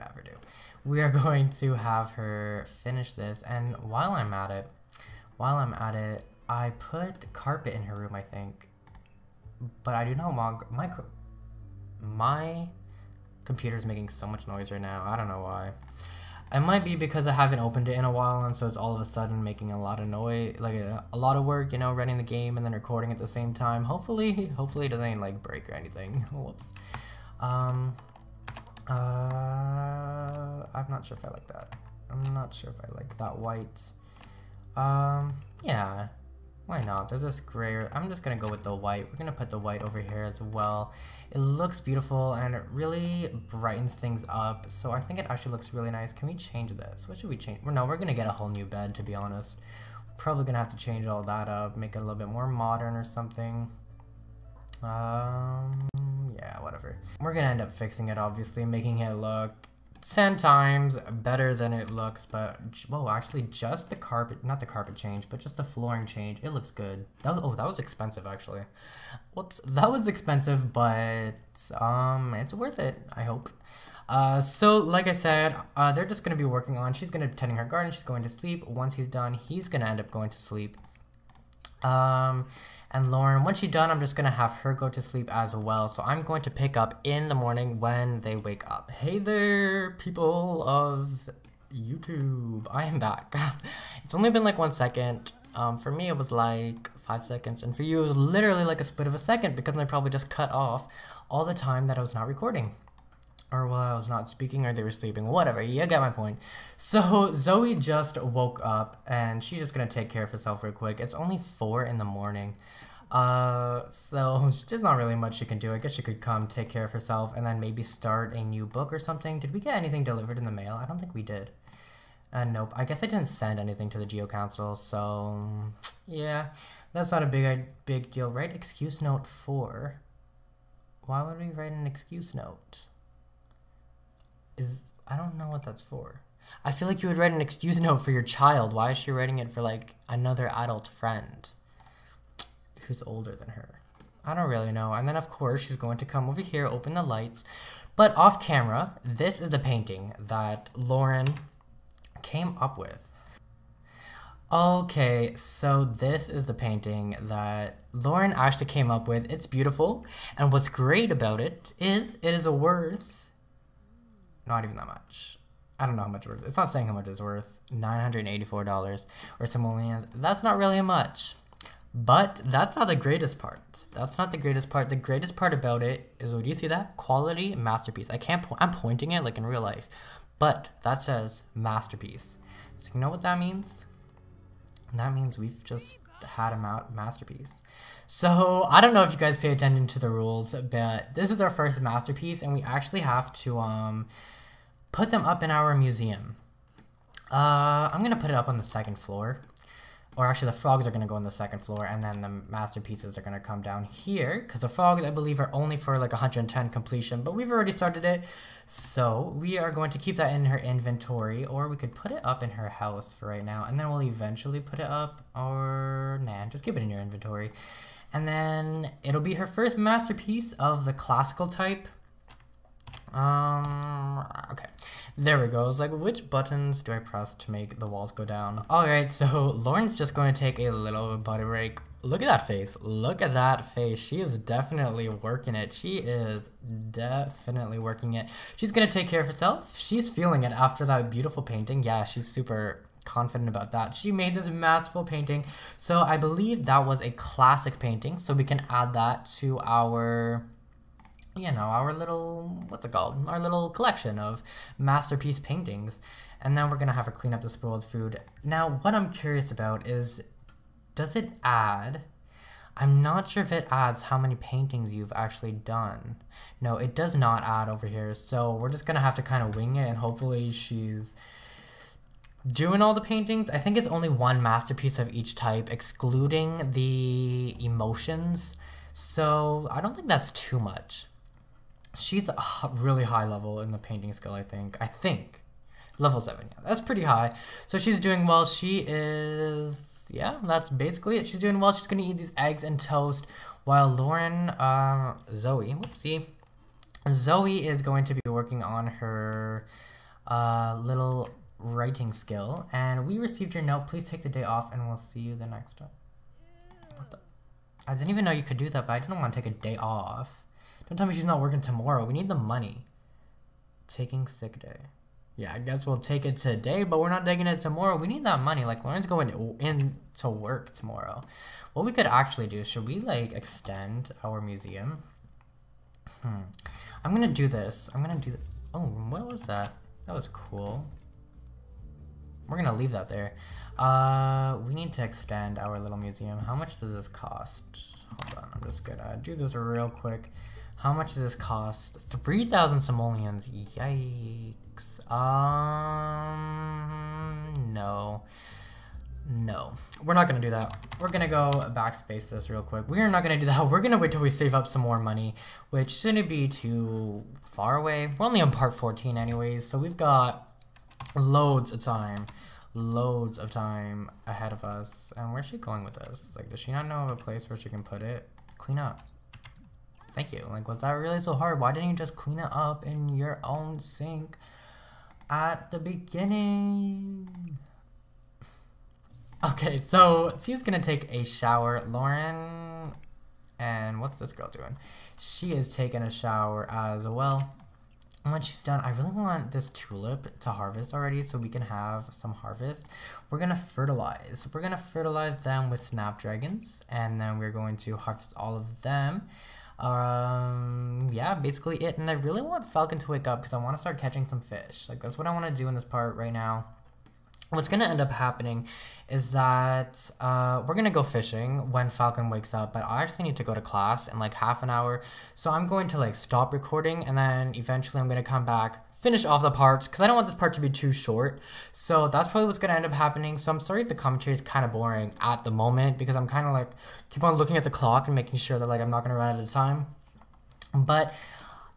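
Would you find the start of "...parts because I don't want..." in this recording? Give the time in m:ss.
6:59.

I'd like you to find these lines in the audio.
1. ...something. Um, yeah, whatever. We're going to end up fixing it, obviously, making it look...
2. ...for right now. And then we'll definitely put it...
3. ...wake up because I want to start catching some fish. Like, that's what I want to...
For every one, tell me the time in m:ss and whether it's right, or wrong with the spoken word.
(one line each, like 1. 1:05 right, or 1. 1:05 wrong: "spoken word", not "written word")
1. 0:53 right
2. 3:33 wrong: "eventually", not "definitely"
3. 6:43 right.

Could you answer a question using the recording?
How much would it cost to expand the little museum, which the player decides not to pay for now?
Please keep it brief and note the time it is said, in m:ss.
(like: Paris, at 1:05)
3,000 simoleons, at 5:42.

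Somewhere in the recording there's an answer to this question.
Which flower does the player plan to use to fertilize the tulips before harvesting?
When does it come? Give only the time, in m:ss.
6:35.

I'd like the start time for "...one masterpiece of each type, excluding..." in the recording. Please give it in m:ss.
4:34.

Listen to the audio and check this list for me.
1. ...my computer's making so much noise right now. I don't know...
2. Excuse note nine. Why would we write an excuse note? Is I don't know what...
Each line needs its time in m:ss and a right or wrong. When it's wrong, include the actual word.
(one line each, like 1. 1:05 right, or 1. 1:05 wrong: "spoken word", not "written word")
1. 0:12 right
2. 2:08 wrong: "four", not "nine".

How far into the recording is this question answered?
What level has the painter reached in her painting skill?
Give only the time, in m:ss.
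4:45.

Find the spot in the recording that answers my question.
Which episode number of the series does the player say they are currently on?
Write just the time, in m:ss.
5:58.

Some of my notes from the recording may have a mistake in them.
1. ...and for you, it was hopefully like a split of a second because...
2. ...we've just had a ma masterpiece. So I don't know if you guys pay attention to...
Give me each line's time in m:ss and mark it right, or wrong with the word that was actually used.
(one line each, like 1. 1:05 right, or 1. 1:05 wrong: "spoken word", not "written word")
1. 1:37 wrong: "literally", not "hopefully"
2. 3:05 right.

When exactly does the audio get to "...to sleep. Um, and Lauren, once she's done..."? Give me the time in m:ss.
1:20.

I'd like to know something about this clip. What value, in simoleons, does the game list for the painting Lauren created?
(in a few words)
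$984.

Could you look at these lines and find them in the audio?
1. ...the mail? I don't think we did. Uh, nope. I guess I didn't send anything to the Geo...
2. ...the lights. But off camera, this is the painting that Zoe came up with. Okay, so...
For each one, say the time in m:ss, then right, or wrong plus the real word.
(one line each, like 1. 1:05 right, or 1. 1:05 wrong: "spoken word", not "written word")
1. 2:00 right
2. 2:26 wrong: "Lauren", not "Zoe".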